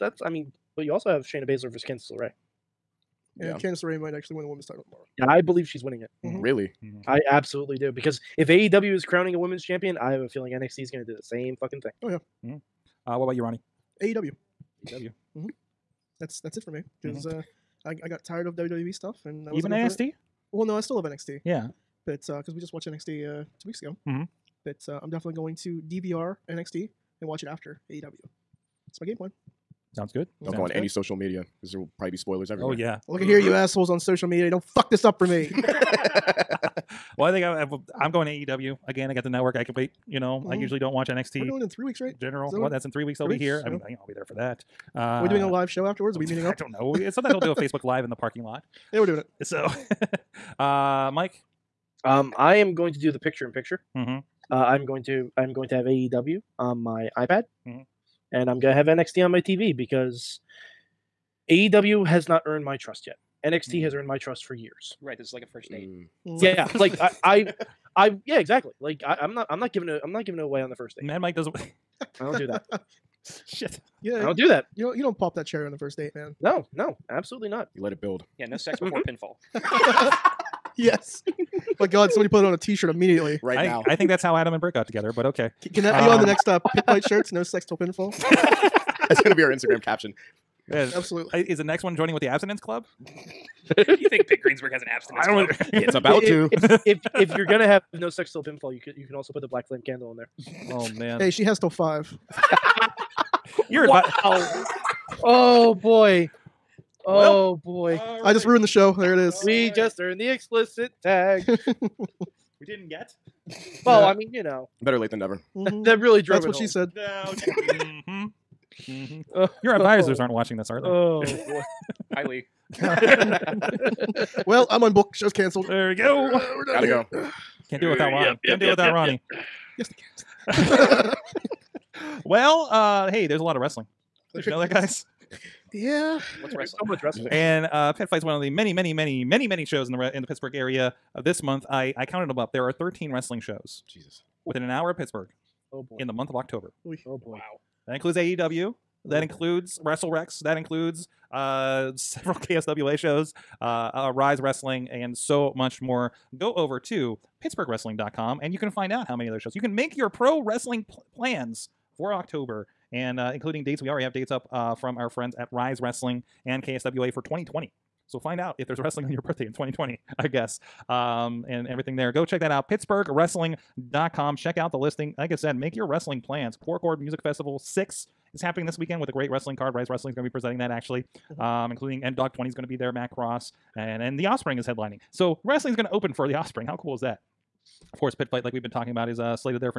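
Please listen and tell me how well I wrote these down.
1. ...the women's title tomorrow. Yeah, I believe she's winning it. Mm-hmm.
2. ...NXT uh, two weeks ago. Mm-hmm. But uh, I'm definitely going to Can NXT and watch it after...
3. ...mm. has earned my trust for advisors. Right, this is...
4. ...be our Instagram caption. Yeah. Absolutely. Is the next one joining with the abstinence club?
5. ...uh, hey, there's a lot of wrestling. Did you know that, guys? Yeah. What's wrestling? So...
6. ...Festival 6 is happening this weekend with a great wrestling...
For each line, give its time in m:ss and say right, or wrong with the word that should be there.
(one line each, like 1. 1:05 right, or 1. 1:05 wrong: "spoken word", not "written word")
1. 0:04 right
2. 0:22 wrong: "DVR", not "Can"
3. 1:03 wrong: "years", not "advisors"
4. 1:29 right
5. 2:12 right
6. 2:57 right.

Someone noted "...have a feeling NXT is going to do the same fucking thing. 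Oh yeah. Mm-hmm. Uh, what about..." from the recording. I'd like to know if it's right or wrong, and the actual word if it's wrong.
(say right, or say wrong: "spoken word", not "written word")
right.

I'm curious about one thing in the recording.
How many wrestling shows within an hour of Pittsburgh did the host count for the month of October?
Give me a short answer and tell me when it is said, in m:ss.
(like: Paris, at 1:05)
13, at 2:22.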